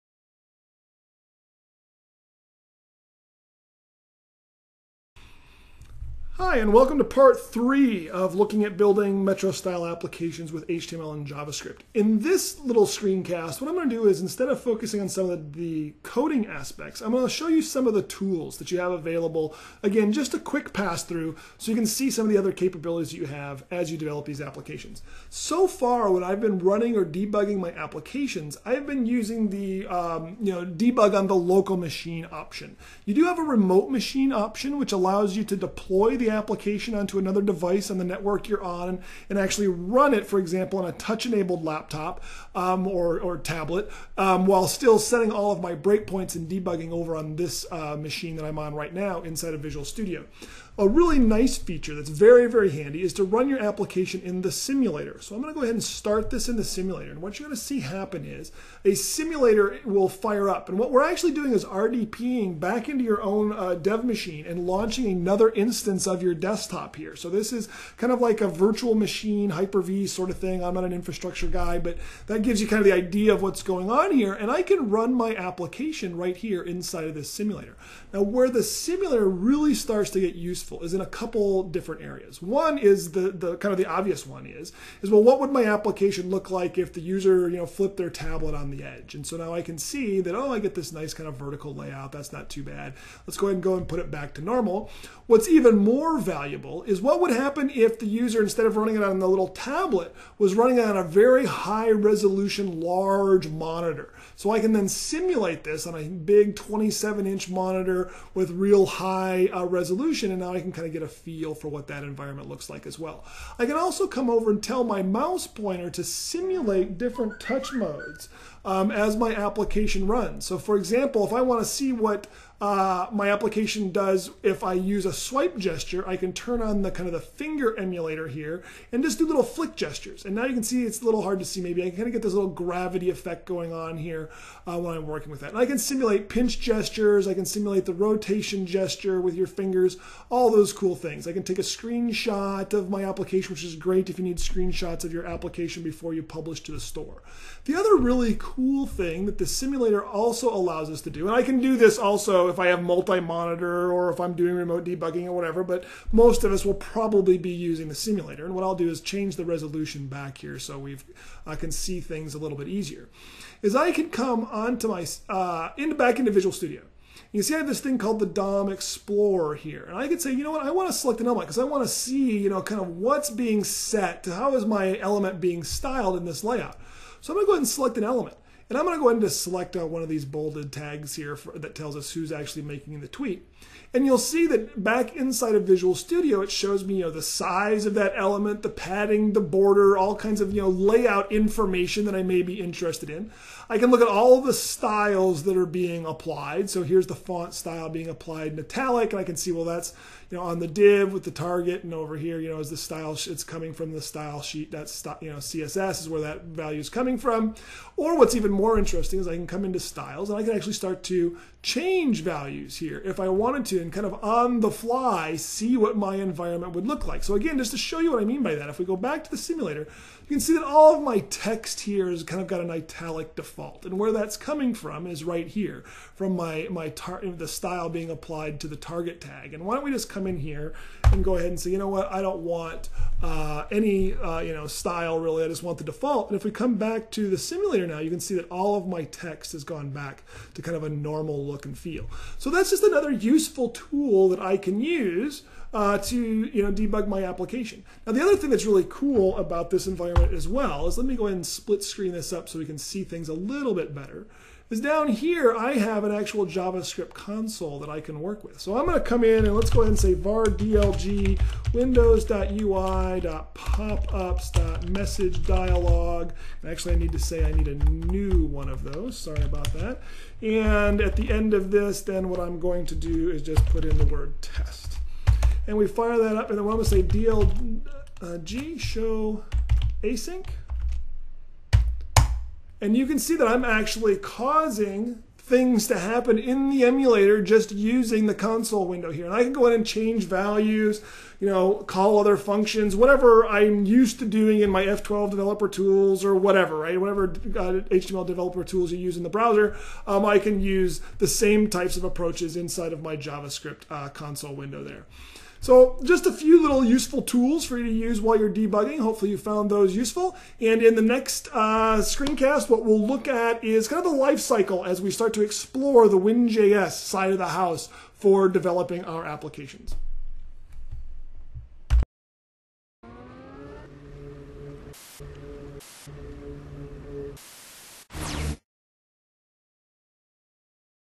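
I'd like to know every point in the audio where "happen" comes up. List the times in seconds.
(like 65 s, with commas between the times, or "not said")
57 s, 97 s, 285 s.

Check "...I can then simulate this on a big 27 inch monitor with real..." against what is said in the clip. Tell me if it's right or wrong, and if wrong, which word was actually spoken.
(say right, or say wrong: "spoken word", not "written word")
right.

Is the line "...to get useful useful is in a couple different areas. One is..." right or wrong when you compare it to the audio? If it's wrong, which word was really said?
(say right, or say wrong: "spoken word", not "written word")
right.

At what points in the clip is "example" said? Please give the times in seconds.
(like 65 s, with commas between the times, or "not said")
40 s, 120 s.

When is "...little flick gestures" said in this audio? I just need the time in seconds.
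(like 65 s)
129 s.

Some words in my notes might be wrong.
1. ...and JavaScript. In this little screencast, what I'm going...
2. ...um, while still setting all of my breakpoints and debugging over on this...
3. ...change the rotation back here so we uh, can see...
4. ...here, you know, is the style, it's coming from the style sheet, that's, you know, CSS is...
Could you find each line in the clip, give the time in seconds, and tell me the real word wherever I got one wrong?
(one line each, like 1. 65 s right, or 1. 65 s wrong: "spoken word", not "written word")
1. 11 s right
2. 44 s right
3. 158 s wrong: "resolution", not "rotation"
4. 202 s right.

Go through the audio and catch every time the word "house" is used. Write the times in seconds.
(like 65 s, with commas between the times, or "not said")
317 s.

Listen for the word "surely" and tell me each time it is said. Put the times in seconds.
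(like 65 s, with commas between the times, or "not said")
not said.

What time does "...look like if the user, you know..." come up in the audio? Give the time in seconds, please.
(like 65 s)
86 s.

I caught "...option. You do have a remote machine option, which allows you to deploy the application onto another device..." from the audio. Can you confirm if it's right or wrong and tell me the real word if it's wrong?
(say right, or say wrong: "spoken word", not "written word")
right.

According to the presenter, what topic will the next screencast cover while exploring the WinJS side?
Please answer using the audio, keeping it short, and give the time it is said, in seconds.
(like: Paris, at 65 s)
The life cycle, at 314 s.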